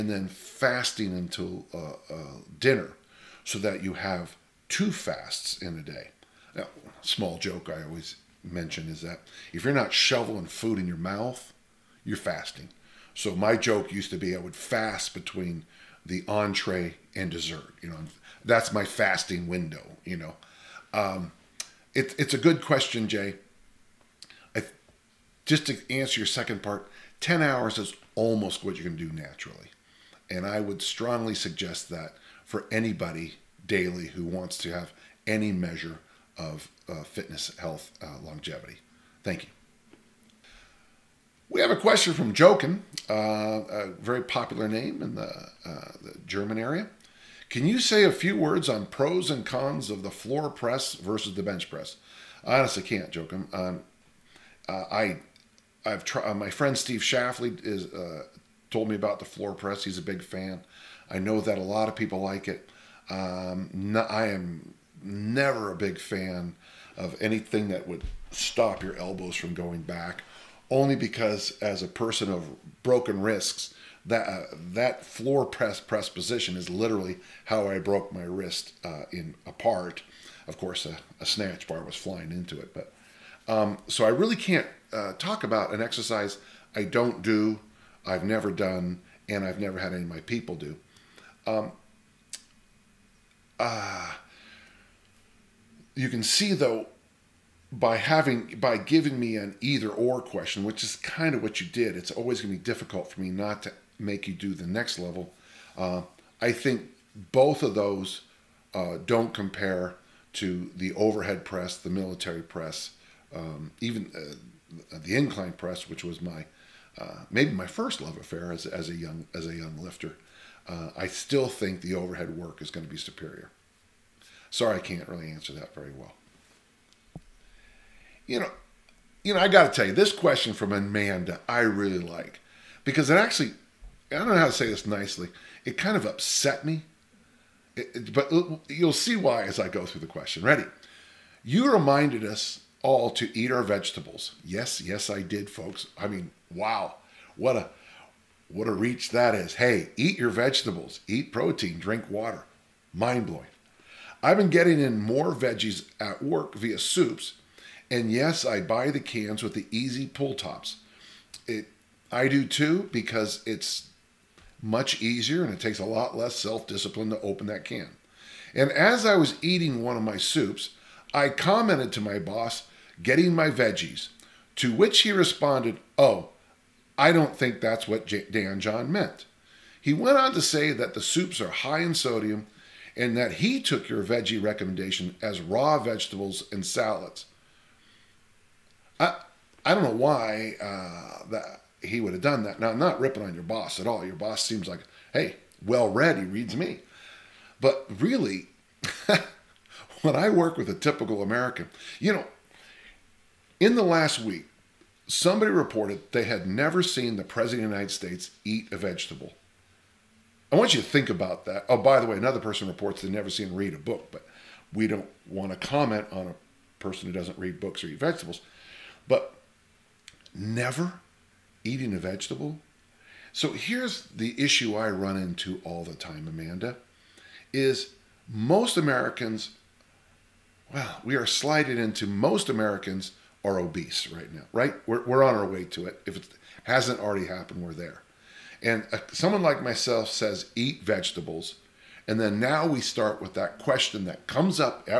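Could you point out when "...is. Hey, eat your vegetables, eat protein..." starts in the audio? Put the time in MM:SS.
02:29.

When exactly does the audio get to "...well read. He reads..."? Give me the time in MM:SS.
03:15.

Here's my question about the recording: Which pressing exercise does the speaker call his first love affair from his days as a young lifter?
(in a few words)
incline press.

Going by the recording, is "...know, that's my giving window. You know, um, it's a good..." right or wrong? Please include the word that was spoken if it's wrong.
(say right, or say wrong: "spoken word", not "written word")
wrong: "fasting", not "giving".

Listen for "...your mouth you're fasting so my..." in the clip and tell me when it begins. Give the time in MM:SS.
00:10.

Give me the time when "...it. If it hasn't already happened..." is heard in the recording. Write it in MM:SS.
03:55.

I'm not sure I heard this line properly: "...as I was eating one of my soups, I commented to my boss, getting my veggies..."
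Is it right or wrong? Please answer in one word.
right.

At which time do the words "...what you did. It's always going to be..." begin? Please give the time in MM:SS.
01:41.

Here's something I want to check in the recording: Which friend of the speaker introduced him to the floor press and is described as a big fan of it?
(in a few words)
Steve Shafley.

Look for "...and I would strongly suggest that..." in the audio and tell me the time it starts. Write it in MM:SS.
00:30.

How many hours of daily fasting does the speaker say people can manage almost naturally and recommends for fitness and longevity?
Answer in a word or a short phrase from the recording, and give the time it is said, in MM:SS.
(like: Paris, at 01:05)
10, at 00:27.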